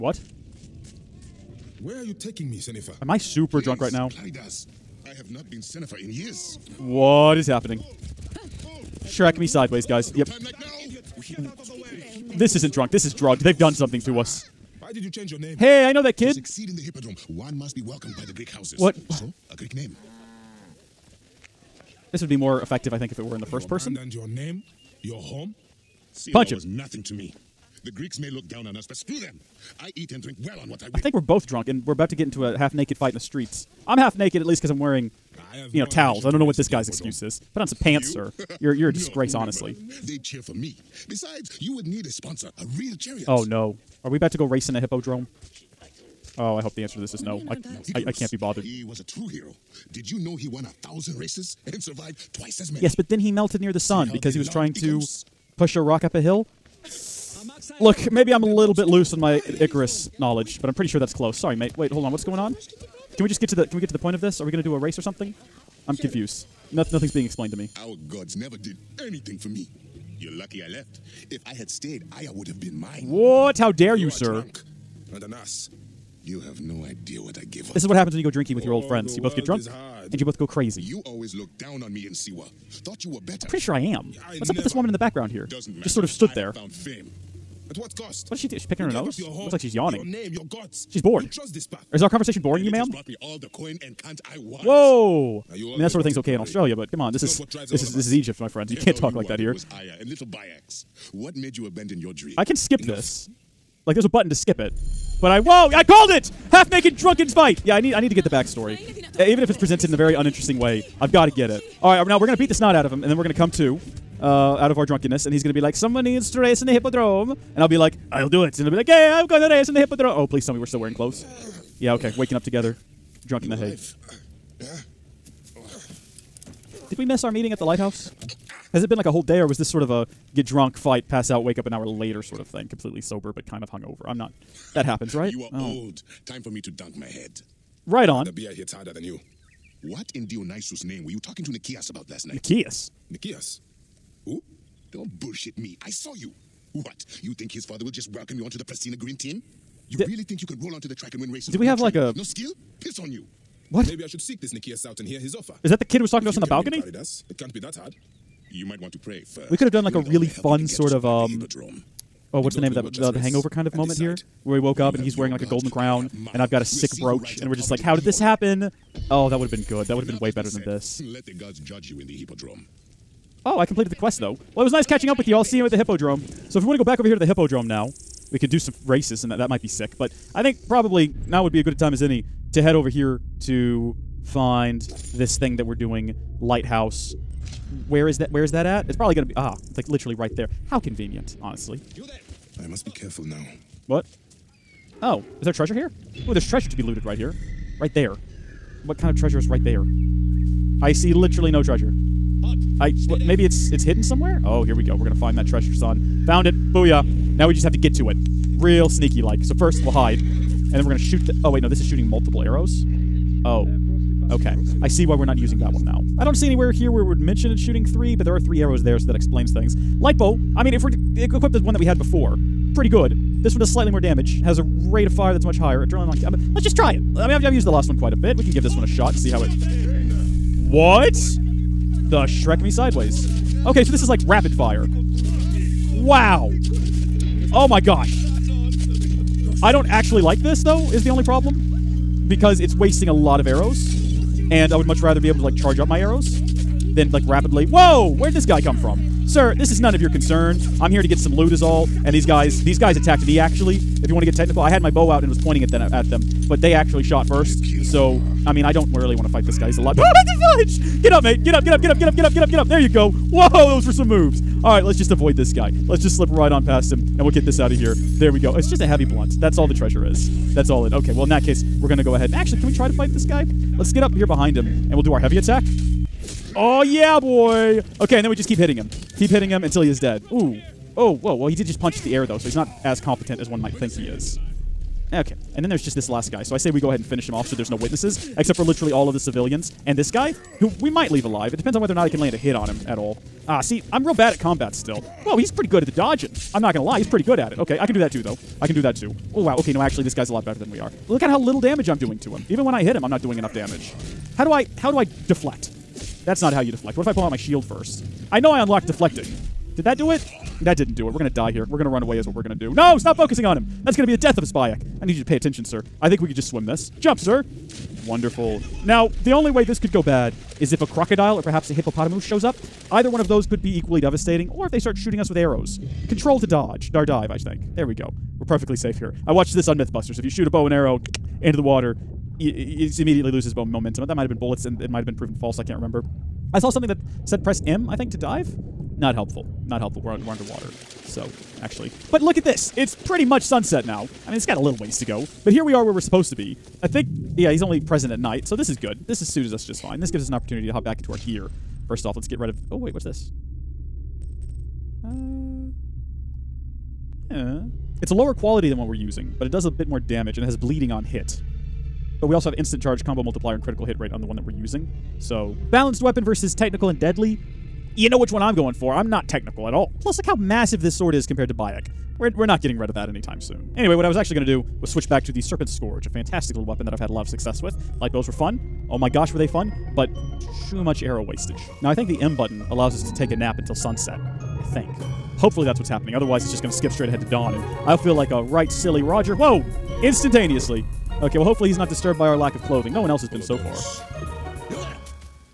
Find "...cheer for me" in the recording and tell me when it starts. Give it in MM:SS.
00:40.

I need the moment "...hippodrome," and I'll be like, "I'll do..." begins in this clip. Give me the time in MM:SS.
01:56.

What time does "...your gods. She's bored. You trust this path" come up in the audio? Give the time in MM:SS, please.
01:30.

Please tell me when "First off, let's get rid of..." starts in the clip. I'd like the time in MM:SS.
05:51.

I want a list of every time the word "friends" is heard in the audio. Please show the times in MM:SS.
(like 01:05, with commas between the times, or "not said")
01:18, 01:38.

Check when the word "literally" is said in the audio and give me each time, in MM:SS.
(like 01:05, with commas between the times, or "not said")
03:09, 03:21, 04:48.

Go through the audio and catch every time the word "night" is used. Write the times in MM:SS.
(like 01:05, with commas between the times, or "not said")
02:22, 05:48.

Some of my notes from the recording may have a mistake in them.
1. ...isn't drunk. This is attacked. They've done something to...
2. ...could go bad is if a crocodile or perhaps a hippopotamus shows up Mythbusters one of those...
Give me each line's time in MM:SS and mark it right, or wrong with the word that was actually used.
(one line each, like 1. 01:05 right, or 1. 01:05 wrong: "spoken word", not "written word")
1. 00:12 wrong: "drugged", not "attacked"
2. 05:19 wrong: "Either", not "Mythbusters".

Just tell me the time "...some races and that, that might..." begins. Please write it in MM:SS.
02:58.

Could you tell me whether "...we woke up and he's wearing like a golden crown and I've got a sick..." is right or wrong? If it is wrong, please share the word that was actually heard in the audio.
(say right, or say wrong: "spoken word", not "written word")
right.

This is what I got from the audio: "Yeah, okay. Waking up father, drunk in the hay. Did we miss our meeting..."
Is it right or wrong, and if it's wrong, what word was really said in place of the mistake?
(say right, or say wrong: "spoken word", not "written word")
wrong: "together", not "father".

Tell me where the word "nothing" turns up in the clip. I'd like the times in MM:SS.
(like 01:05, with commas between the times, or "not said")
00:26, 01:06.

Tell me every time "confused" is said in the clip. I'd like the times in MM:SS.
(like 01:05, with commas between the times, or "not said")
01:05.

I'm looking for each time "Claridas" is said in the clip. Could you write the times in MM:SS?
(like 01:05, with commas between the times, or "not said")
00:04.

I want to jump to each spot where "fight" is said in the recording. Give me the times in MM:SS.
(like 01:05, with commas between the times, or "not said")
00:32, 01:47, 02:10, 04:19, 04:32.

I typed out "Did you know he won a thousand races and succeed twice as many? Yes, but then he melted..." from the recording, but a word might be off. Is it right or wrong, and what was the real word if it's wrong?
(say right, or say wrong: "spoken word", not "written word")
wrong: "survived", not "succeed".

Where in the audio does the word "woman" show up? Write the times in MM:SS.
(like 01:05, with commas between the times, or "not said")
01:24.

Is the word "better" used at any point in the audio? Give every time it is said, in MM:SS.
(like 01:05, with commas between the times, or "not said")
01:23, 02:50, 05:00.